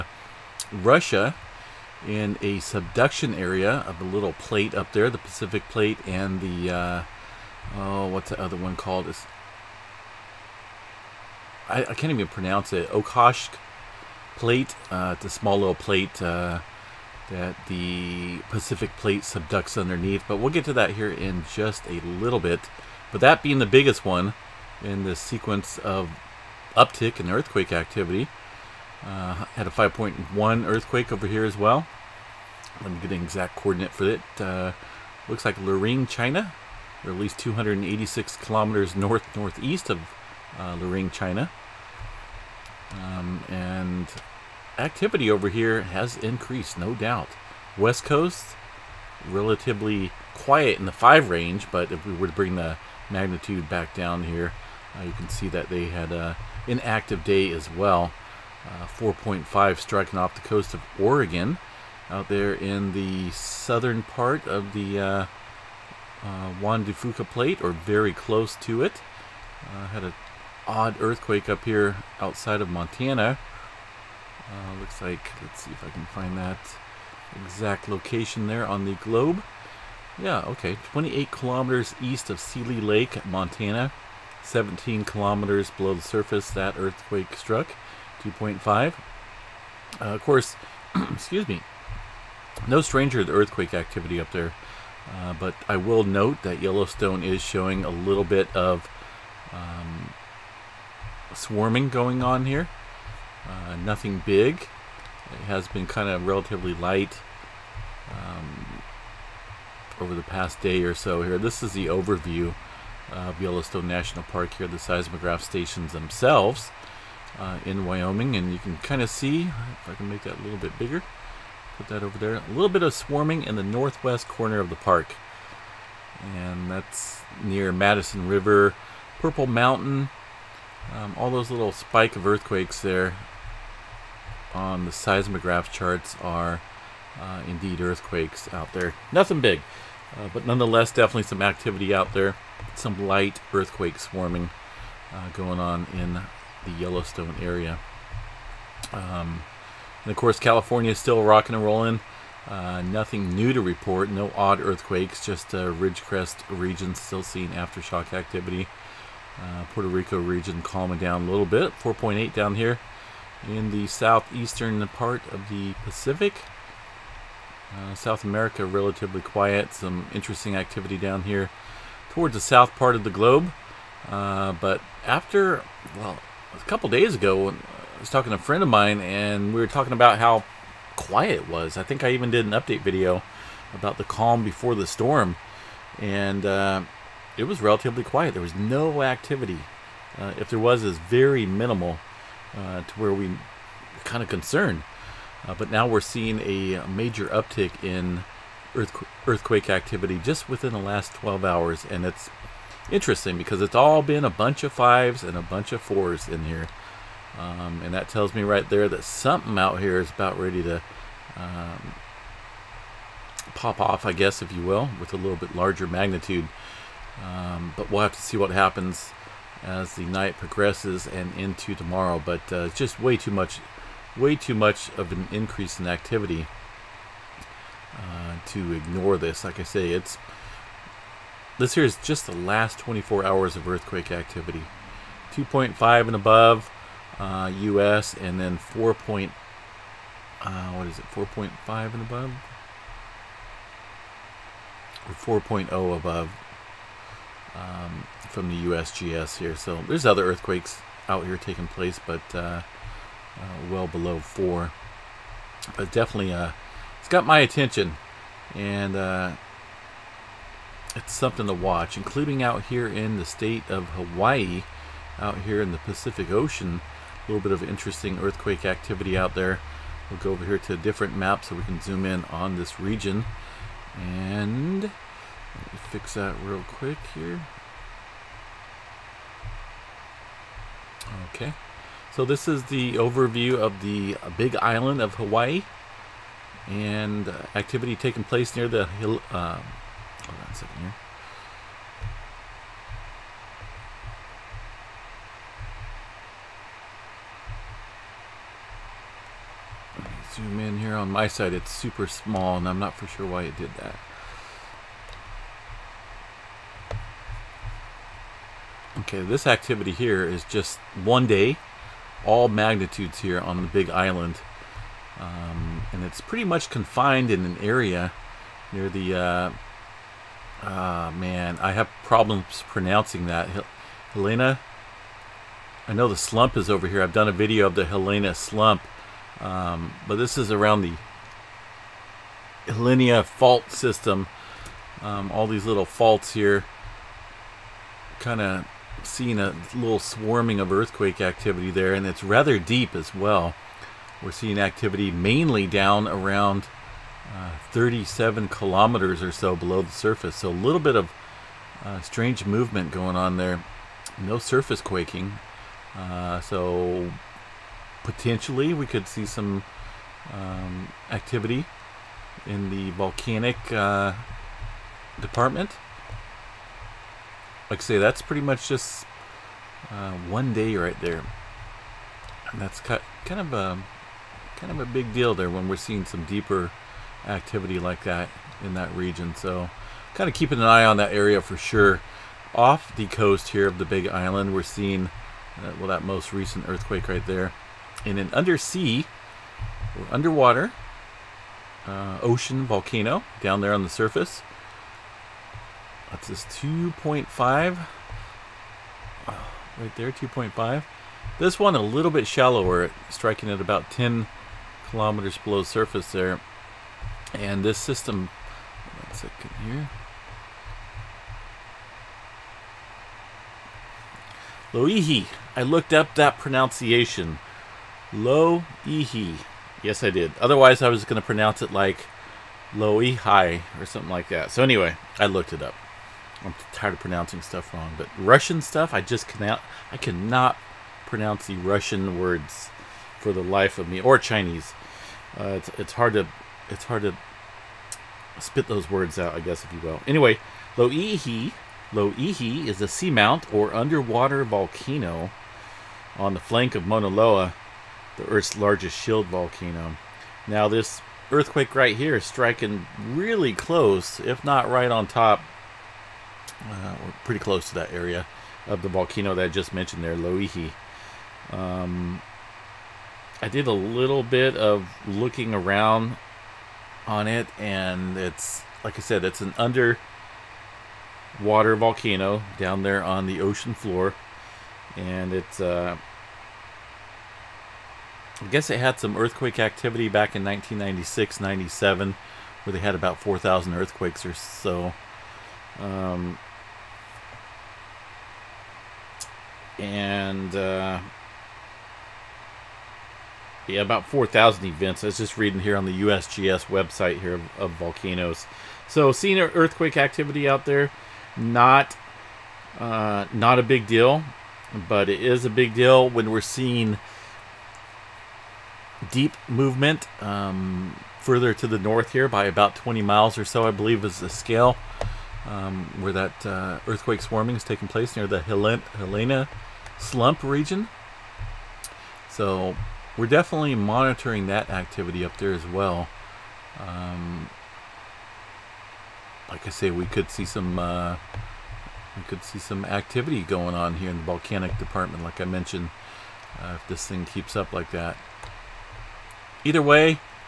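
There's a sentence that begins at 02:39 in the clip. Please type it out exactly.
Uh, Puerto Rico region calming down a little bit, 4.8 down here in the southeastern part of the Pacific.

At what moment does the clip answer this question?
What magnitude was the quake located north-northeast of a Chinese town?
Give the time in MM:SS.
00:29.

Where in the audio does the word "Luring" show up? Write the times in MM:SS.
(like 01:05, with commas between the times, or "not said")
00:35, 00:40.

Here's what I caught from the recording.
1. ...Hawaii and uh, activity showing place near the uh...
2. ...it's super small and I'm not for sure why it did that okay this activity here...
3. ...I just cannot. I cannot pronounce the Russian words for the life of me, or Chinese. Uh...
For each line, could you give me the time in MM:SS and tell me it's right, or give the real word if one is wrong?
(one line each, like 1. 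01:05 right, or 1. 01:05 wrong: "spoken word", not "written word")
1. 04:45 wrong: "taking", not "showing"
2. 05:01 right
3. 07:08 right.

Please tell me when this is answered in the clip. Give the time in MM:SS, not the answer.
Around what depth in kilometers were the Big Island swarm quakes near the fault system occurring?
05:47.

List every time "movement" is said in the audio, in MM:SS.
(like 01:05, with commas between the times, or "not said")
05:52, 08:29.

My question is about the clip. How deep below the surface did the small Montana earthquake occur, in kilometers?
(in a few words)
17.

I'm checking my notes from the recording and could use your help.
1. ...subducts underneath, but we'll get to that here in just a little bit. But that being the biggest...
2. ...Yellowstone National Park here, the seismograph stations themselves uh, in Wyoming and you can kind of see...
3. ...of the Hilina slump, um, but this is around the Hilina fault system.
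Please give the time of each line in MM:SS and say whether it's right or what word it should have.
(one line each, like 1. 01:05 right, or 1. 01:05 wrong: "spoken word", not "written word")
1. 00:19 right
2. 01:53 right
3. 05:27 right.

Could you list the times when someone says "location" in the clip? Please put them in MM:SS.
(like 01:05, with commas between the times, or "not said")
01:17.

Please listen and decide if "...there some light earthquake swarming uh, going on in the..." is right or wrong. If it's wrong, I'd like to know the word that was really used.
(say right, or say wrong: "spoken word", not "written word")
right.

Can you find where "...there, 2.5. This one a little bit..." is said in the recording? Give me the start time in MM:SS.
06:39.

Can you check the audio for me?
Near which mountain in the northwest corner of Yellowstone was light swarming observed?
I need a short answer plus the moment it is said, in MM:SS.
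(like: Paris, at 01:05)
Purple Mountain, at 02:09.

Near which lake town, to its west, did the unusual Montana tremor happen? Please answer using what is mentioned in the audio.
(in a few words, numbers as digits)
Seeley Lake.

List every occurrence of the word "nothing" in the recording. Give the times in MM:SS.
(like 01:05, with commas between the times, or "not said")
01:43, 02:19, 02:32.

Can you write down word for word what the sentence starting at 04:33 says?
And let me fix that real quick here.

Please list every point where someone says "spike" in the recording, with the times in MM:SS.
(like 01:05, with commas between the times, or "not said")
02:11.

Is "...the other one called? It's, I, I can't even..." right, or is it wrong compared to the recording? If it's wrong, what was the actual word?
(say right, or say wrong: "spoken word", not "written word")
right.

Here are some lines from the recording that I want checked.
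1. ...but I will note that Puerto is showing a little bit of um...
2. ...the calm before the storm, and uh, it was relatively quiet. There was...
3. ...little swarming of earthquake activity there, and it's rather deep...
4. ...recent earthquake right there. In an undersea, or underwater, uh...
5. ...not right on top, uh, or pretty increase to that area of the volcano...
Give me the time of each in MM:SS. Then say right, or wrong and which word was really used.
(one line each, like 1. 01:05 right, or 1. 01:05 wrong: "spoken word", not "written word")
1. 01:35 wrong: "Yellowstone", not "Puerto"
2. 03:03 right
3. 05:39 right
4. 06:26 right
5. 07:34 wrong: "close", not "increase".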